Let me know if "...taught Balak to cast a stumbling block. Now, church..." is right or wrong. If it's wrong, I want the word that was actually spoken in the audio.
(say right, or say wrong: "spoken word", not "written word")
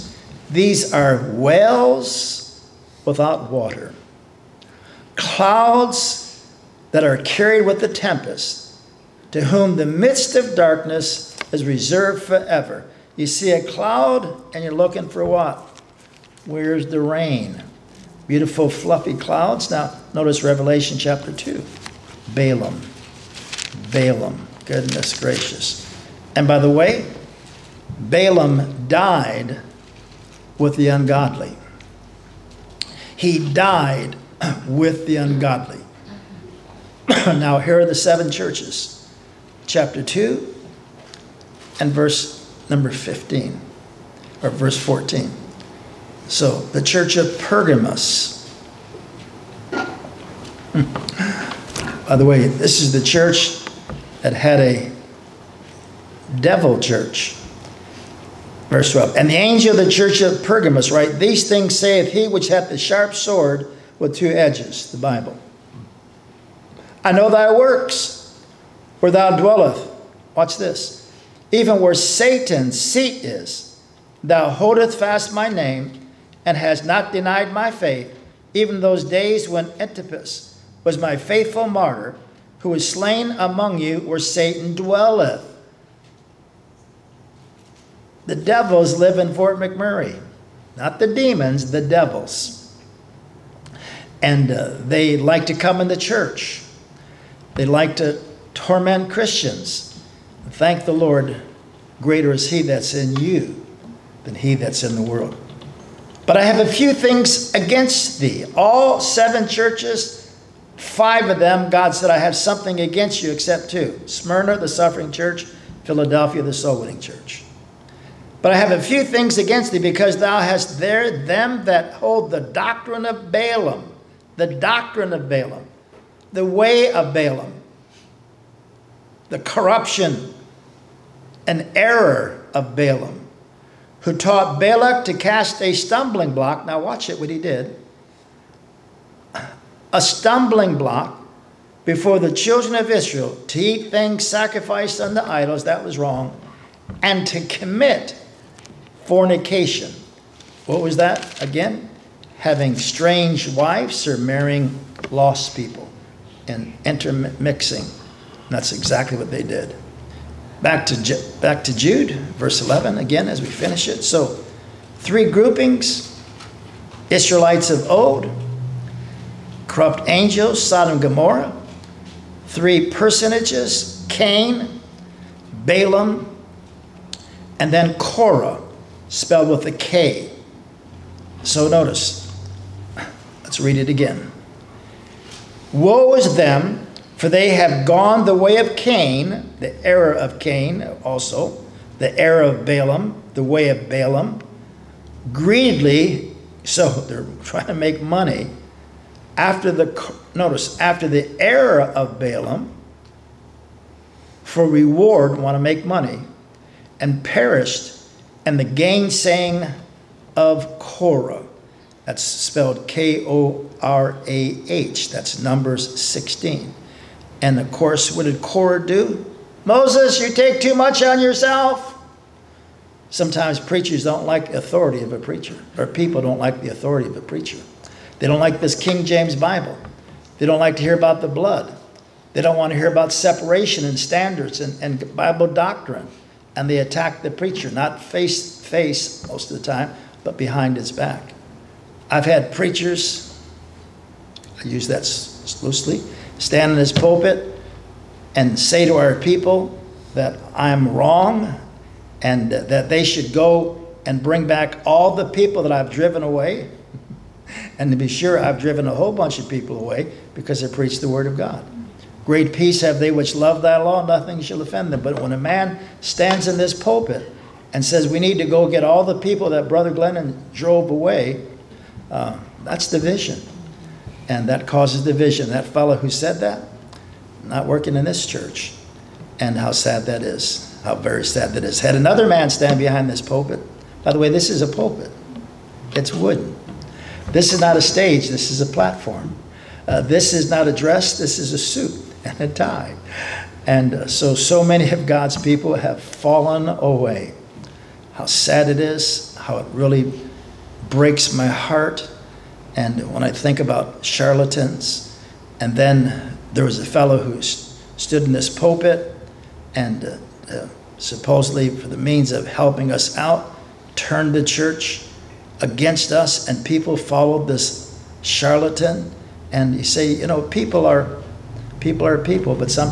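wrong: "watch", not "church".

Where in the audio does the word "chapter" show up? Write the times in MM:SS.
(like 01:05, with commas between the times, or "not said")
00:20, 00:39.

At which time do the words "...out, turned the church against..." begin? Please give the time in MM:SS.
05:13.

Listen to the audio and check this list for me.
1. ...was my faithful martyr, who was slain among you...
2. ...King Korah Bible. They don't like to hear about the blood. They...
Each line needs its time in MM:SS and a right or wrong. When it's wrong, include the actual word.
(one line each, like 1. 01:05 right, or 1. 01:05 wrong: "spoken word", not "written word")
1. 01:20 right
2. 03:48 wrong: "James", not "Korah".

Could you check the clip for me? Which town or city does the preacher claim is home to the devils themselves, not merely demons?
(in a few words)
Fort McMurray.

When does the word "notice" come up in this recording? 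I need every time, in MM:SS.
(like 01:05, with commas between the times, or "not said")
00:20, 03:01, 03:20.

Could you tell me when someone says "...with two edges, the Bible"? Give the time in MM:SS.
01:04.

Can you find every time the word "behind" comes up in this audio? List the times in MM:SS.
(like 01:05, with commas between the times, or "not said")
04:00, 04:42.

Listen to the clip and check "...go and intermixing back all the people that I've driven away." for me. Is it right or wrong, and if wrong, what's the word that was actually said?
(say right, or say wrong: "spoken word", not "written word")
wrong: "bring", not "intermixing".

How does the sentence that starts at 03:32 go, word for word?
That's spelled K O R A H.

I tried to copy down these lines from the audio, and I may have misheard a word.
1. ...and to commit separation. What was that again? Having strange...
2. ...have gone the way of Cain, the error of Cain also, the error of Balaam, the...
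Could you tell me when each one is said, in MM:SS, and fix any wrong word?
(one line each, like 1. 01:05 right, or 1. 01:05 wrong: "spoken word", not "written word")
1. 02:27 wrong: "fornication", not "separation"
2. 03:07 right.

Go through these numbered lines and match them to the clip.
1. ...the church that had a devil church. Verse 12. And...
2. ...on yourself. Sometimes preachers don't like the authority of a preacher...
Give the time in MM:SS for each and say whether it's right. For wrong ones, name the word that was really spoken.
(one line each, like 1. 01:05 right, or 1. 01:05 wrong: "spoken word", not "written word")
1. 00:52 right
2. 03:41 right.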